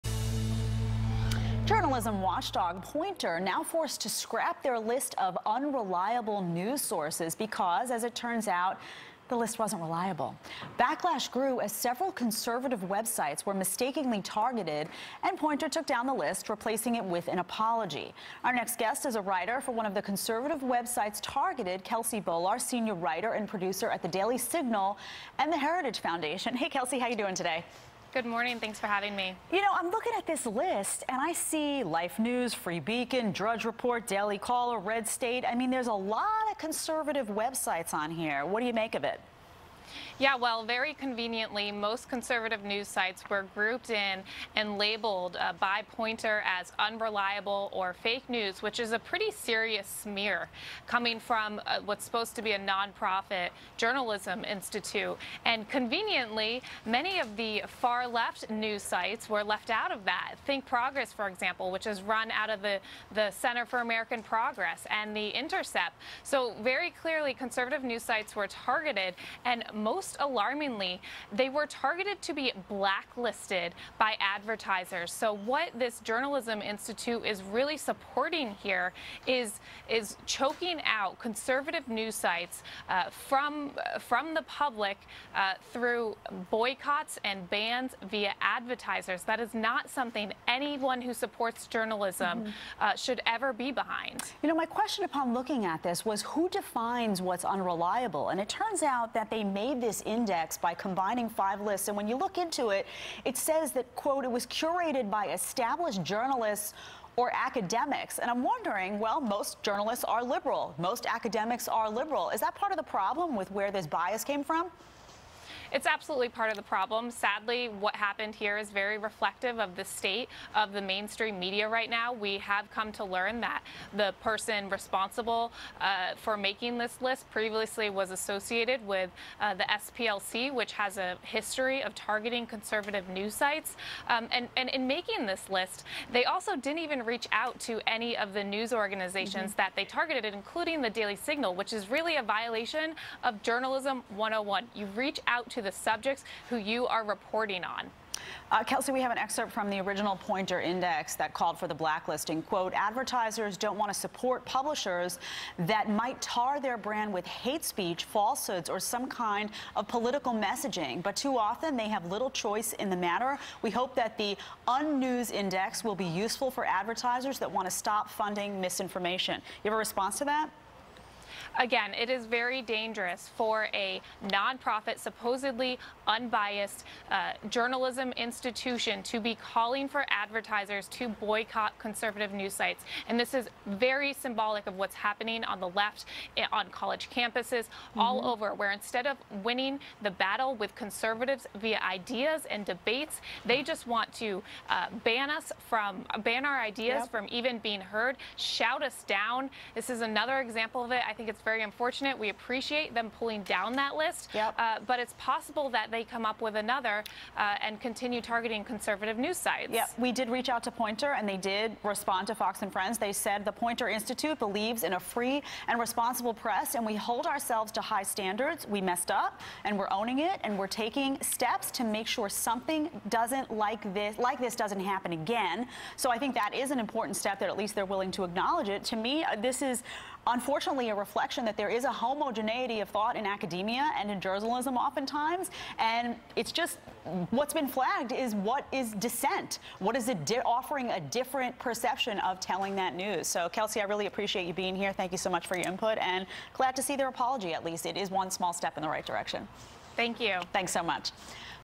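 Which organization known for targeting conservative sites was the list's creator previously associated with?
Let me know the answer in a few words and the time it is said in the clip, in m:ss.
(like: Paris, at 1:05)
SPLC, at 2:09.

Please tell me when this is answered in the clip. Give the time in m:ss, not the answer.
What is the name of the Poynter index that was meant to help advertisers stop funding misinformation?
2:44.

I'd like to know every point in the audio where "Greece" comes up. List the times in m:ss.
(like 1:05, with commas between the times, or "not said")
not said.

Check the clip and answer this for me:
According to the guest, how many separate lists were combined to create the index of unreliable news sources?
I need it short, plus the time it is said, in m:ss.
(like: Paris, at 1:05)
5, at 1:41.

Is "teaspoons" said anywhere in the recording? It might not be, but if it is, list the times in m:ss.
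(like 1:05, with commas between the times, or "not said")
not said.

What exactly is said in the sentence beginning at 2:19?
that they targeted, including the Daily Signal, which is really a violation of Journalism 101.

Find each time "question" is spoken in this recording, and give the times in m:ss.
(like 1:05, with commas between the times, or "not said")
1:34.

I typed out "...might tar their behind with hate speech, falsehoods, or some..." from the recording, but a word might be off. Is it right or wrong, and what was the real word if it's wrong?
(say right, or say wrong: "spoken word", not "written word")
wrong: "brand", not "behind".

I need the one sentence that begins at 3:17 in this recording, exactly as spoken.
from even being heard, shout us down.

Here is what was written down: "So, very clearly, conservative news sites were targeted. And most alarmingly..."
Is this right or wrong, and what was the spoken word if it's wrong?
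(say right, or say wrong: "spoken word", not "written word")
right.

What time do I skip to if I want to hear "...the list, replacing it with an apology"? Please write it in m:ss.
0:16.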